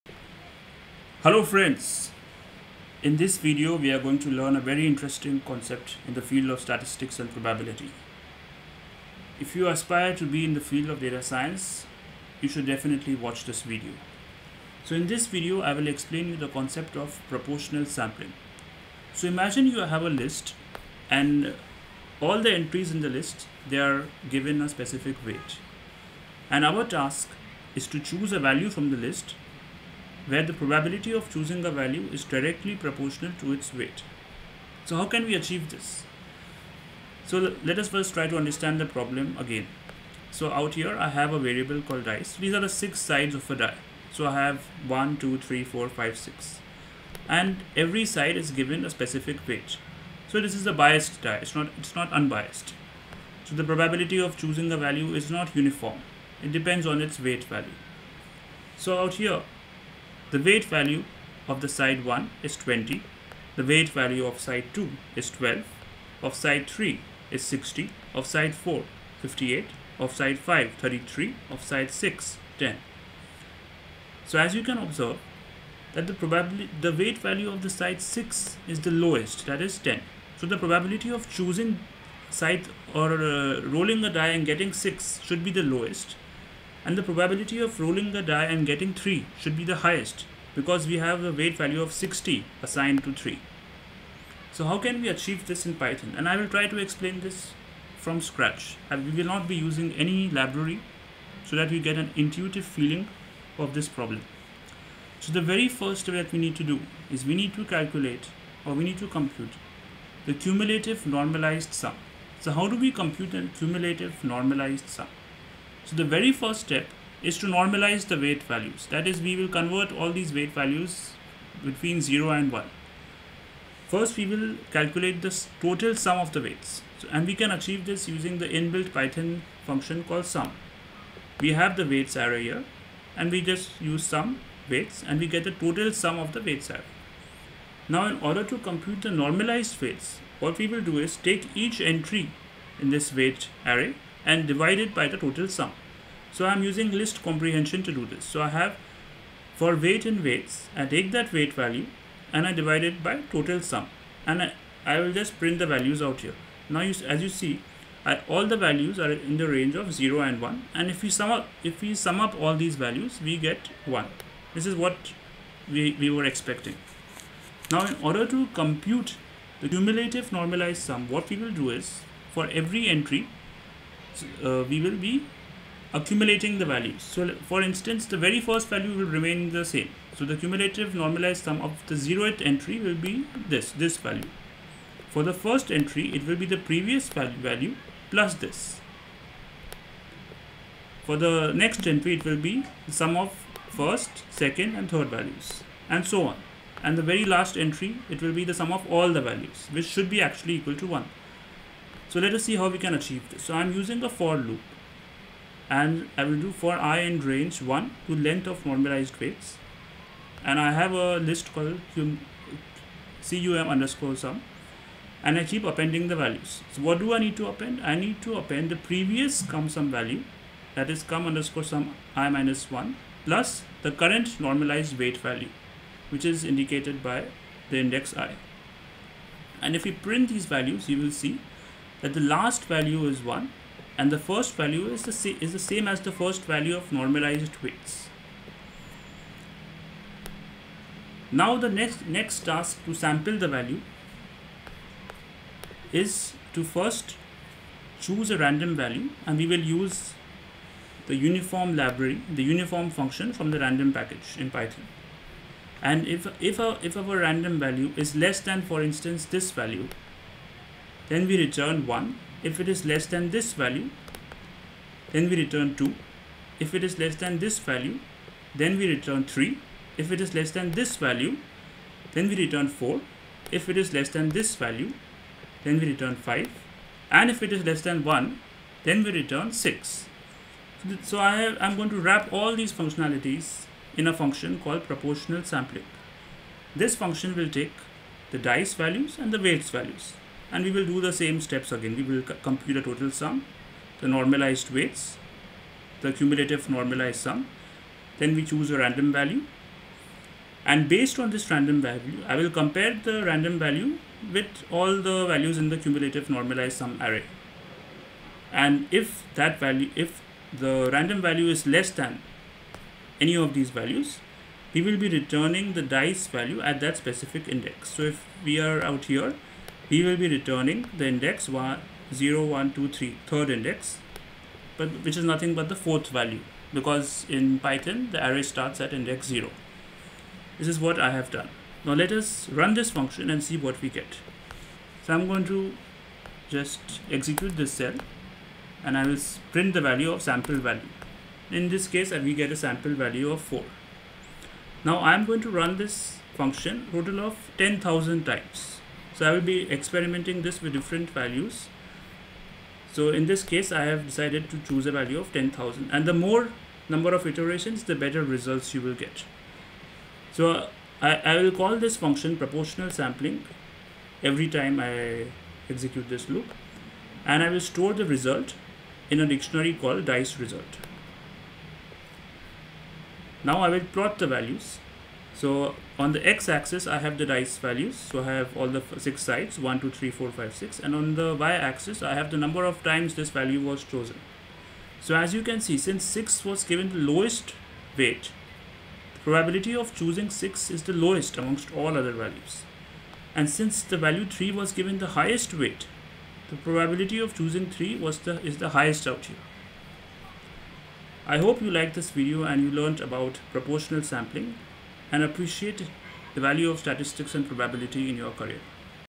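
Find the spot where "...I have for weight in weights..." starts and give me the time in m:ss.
2:28.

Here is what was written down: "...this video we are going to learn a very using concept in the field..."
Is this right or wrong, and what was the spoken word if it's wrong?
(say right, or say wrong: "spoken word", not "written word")
wrong: "interesting", not "using".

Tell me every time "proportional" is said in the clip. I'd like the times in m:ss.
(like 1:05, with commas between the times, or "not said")
0:17, 0:32, 4:44, 6:02, 6:43.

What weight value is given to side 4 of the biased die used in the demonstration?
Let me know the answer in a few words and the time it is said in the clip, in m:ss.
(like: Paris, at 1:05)
58, at 1:09.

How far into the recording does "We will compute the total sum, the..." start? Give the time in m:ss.
4:51.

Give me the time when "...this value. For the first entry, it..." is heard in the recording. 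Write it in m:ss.
3:03.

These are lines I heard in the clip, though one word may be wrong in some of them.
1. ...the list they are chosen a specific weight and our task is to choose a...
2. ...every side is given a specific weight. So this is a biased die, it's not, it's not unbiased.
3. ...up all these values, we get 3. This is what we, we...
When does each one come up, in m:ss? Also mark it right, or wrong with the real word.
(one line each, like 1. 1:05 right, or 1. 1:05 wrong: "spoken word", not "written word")
1. 0:23 wrong: "given", not "chosen"
2. 0:47 right
3. 2:42 wrong: "1", not "3".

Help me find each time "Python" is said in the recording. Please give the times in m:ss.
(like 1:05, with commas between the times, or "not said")
1:35, 2:08, 4:14, 5:27.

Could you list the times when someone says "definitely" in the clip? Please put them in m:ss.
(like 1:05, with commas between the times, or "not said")
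0:12.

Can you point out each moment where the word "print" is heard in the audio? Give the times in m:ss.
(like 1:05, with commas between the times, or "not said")
2:35, 3:49, 5:39.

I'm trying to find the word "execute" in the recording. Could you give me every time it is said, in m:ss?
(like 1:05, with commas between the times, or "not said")
5:37, 6:05.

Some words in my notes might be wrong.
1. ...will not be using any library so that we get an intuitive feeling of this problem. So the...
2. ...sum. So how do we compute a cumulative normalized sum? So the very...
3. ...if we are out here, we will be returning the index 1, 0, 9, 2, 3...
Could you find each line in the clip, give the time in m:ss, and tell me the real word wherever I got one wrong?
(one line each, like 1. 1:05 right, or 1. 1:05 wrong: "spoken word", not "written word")
1. 1:39 right
2. 1:51 right
3. 5:18 wrong: "1", not "9".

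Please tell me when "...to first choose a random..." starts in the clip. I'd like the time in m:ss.
4:06.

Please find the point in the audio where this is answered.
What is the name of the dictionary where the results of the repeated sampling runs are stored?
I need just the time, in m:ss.
6:10.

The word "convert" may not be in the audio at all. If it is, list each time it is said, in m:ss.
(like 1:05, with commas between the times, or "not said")
1:59.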